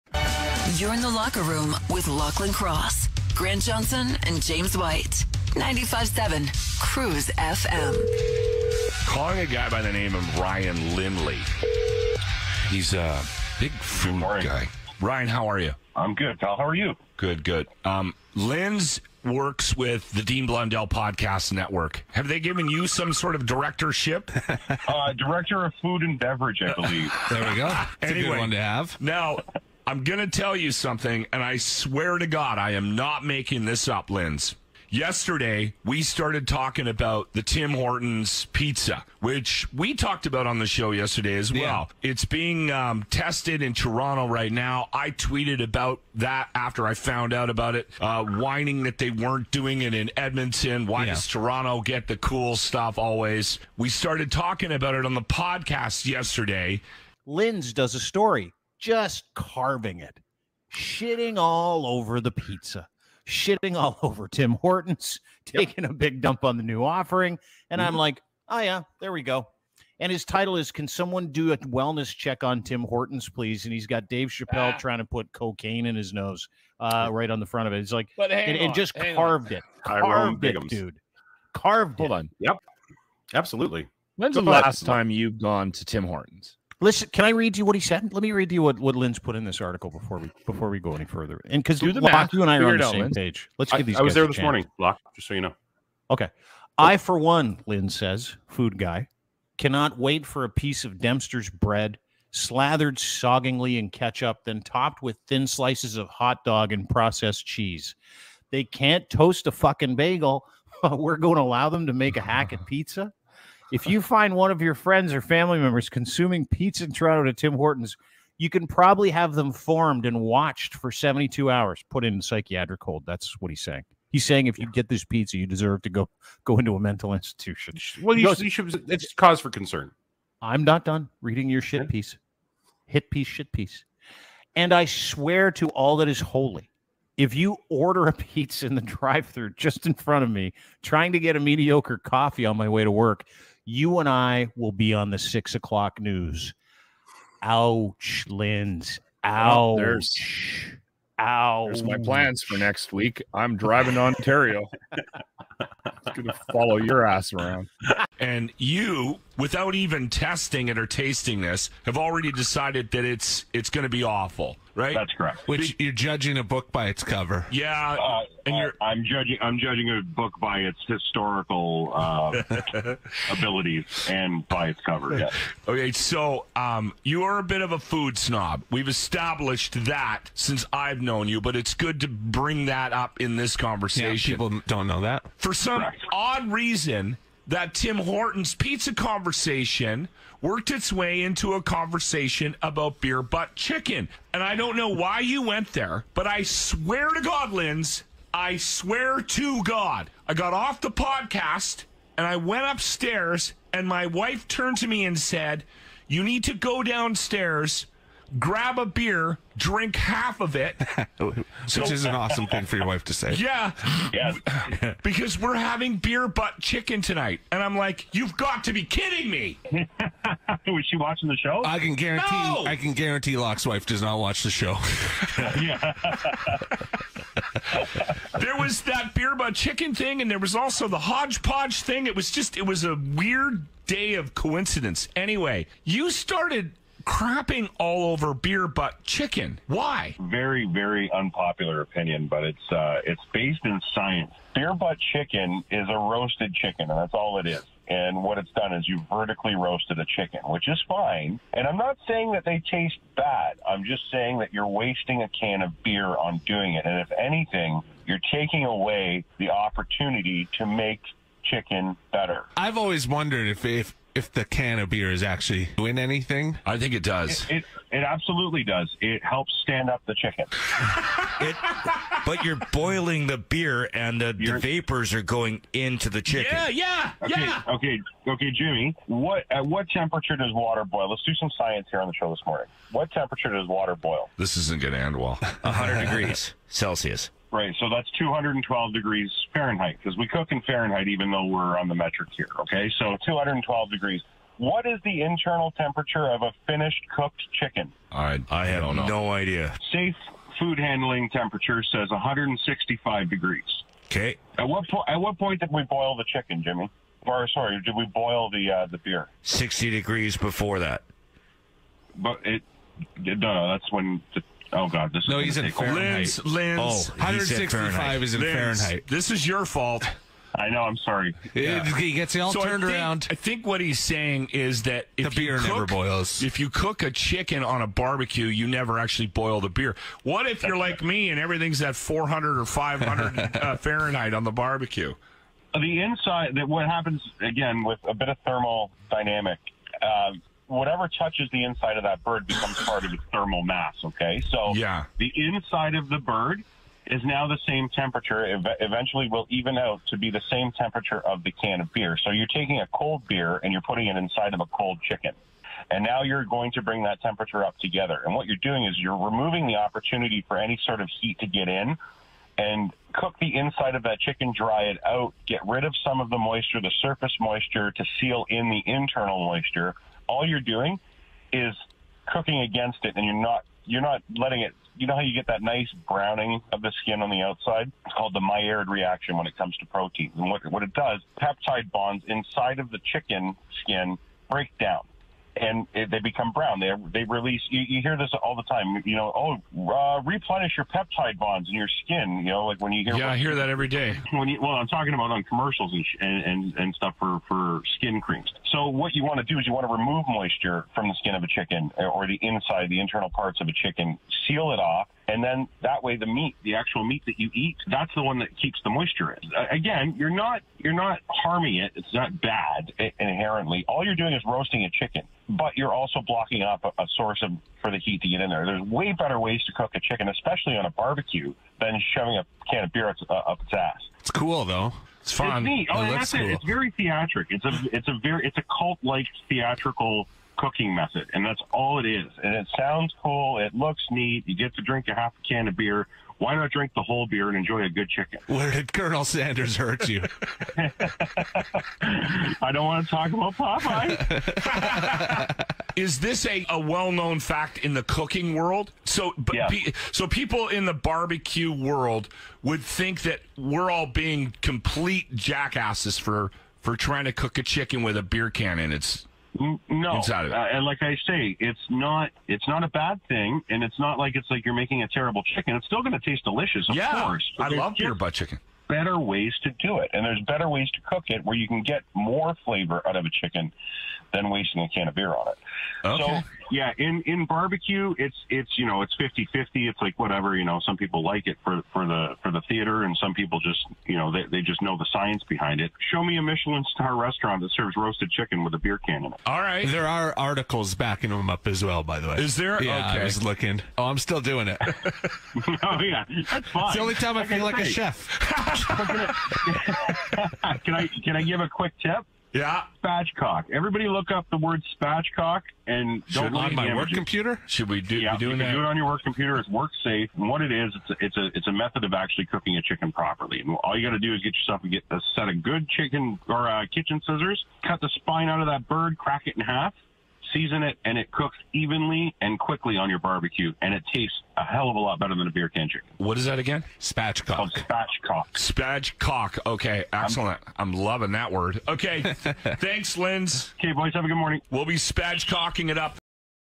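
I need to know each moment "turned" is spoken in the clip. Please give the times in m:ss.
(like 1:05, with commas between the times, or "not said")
3:24, 5:22.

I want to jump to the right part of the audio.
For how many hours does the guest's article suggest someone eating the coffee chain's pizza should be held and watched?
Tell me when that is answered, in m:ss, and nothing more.
2:00.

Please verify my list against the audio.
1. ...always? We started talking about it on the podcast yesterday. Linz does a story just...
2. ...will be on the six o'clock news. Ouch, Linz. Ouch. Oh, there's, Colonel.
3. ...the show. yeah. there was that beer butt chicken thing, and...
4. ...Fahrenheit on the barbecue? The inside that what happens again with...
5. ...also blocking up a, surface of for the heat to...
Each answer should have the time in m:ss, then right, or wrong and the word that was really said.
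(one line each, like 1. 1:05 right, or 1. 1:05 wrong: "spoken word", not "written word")
1. 0:52 right
2. 2:24 wrong: "Ouch", not "Colonel"
3. 3:44 right
4. 5:33 right
5. 6:55 wrong: "source", not "surface".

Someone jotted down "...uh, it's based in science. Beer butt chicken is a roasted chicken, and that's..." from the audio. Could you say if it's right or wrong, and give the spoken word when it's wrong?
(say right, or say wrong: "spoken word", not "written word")
right.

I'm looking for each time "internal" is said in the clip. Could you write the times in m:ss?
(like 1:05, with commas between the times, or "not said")
4:55, 6:08, 6:43.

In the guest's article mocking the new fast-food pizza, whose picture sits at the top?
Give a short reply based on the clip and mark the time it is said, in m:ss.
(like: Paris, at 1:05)
Dave Chappelle, at 1:14.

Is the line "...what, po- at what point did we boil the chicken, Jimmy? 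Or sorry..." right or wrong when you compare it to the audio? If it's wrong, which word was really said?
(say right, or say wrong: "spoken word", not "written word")
right.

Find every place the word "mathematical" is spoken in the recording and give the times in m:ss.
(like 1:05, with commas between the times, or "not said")
not said.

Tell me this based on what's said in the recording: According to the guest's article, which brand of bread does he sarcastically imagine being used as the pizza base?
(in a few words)
Dempster's.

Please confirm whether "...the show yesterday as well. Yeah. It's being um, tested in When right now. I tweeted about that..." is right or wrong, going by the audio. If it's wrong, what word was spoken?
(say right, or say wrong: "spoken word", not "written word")
wrong: "Toronto", not "When".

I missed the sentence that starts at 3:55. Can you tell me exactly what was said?
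Anyway, you started crapping all over beer butt chicken.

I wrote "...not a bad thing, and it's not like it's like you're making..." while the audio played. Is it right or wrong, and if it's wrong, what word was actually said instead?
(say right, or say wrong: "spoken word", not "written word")
right.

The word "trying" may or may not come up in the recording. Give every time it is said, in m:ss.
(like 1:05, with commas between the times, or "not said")
1:14, 2:20, 7:36.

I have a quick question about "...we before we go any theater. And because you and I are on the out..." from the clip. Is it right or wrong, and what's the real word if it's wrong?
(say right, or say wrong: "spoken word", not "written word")
wrong: "further", not "theater".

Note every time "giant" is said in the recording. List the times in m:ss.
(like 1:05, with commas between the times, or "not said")
not said.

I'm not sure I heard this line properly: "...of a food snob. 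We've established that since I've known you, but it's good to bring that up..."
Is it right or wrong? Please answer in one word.
right.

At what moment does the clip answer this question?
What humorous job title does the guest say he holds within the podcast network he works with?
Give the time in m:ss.
0:25.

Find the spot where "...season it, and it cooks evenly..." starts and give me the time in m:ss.
8:40.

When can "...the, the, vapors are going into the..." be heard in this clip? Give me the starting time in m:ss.
4:34.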